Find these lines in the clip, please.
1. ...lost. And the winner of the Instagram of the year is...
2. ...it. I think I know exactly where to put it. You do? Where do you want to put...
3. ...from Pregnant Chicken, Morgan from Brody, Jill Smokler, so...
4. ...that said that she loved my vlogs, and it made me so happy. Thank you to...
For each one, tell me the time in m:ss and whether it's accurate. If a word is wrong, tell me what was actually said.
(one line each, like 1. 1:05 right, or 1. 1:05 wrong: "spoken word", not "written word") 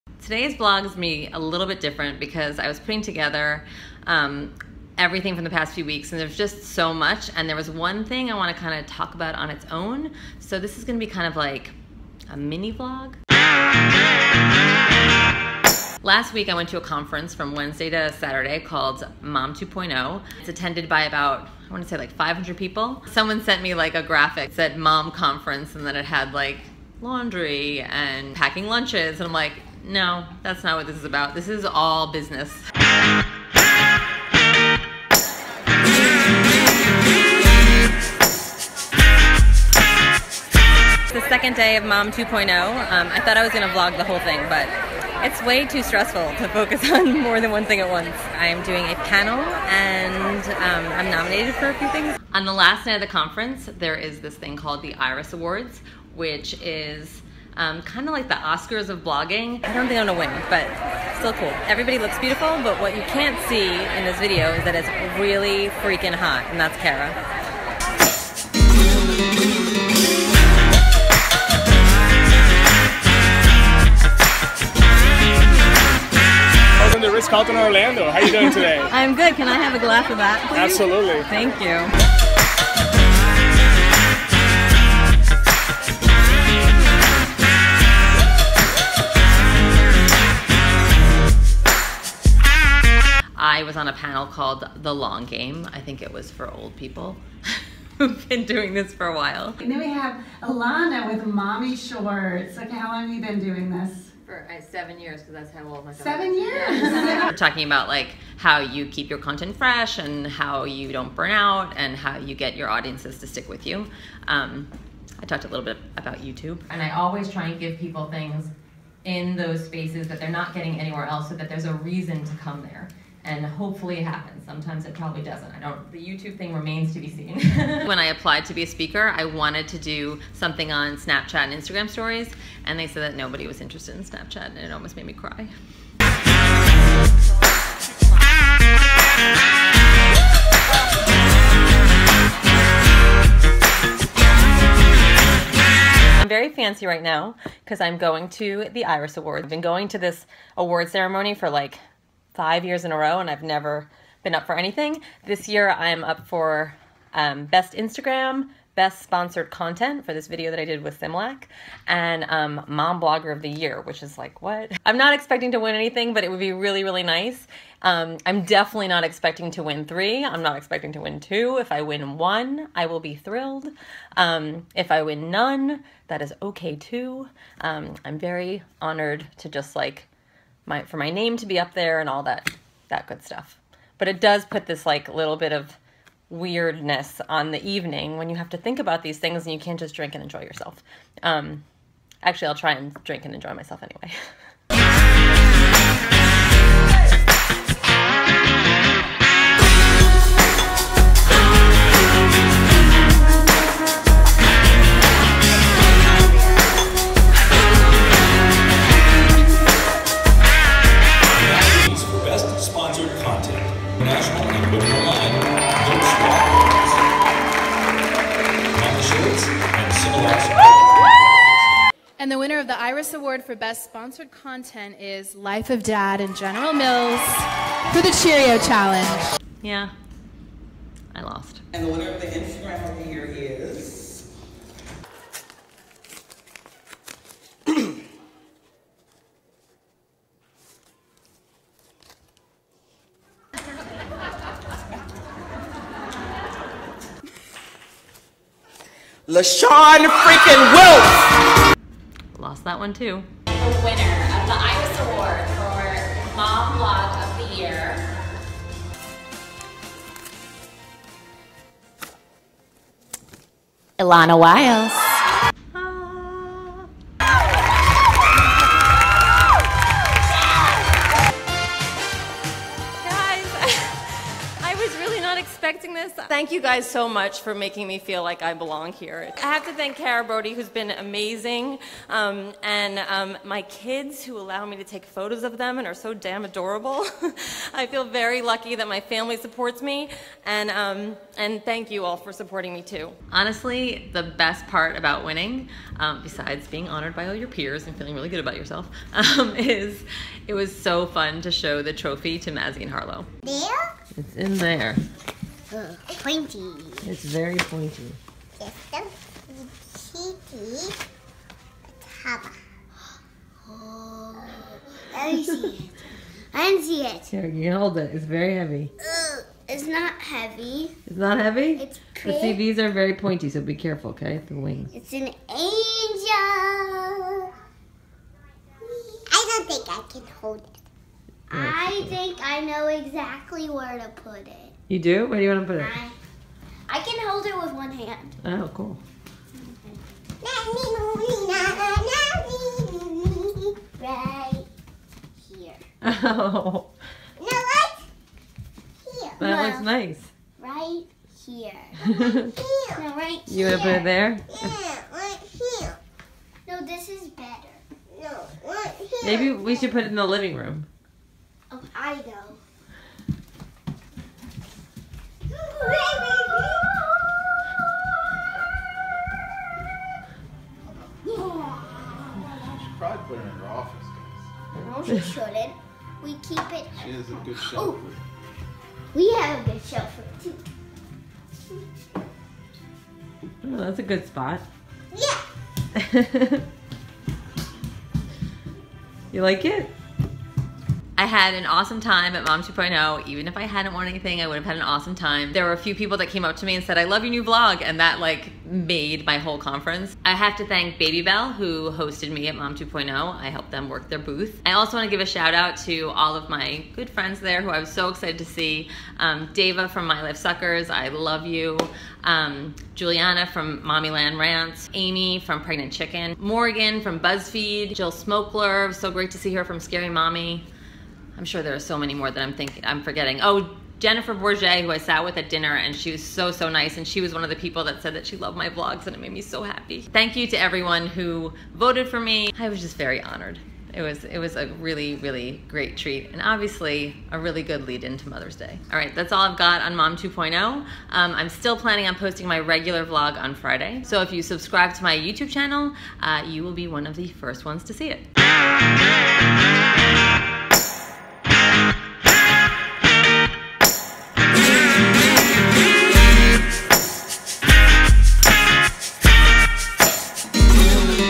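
1. 3:51 right
2. 5:30 right
3. 6:55 wrong: "BuzzFeed", not "Brody"
4. 7:07 right.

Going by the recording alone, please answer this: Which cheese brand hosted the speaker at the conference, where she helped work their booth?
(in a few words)
Babybel.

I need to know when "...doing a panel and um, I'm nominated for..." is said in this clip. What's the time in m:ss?
0:48.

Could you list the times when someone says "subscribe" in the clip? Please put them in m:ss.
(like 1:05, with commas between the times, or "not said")
7:24.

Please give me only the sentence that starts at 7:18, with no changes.
All right, that's all I've got on Mom 2.0.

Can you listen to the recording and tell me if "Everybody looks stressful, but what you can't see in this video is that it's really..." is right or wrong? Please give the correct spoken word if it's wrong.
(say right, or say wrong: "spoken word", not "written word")
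wrong: "beautiful", not "stressful".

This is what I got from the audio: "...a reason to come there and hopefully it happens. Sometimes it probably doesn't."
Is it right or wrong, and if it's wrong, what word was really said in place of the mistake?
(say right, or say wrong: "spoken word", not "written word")
right.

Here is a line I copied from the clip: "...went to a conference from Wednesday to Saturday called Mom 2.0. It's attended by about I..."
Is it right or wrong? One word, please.
right.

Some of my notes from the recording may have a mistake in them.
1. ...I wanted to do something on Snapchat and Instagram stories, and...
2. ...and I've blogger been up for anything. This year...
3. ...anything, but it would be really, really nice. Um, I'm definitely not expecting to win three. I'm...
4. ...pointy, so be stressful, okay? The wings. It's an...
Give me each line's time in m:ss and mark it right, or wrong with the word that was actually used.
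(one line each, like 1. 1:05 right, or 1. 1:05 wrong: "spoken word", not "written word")
1. 2:09 right
2. 2:33 wrong: "never", not "blogger"
3. 2:45 right
4. 5:23 wrong: "careful", not "stressful".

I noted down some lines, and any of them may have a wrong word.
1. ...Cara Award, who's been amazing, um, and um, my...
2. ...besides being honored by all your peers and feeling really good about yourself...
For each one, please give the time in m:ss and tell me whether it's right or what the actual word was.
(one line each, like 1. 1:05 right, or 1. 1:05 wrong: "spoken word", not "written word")
1. 4:39 wrong: "Brody", not "Award"
2. 4:56 right.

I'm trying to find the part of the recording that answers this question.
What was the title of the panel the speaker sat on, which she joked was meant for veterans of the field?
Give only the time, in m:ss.
1:34.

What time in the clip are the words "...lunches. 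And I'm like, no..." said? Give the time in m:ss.
0:28.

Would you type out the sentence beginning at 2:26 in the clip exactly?
I'm very fancy right now because I'm going to the Iris Award.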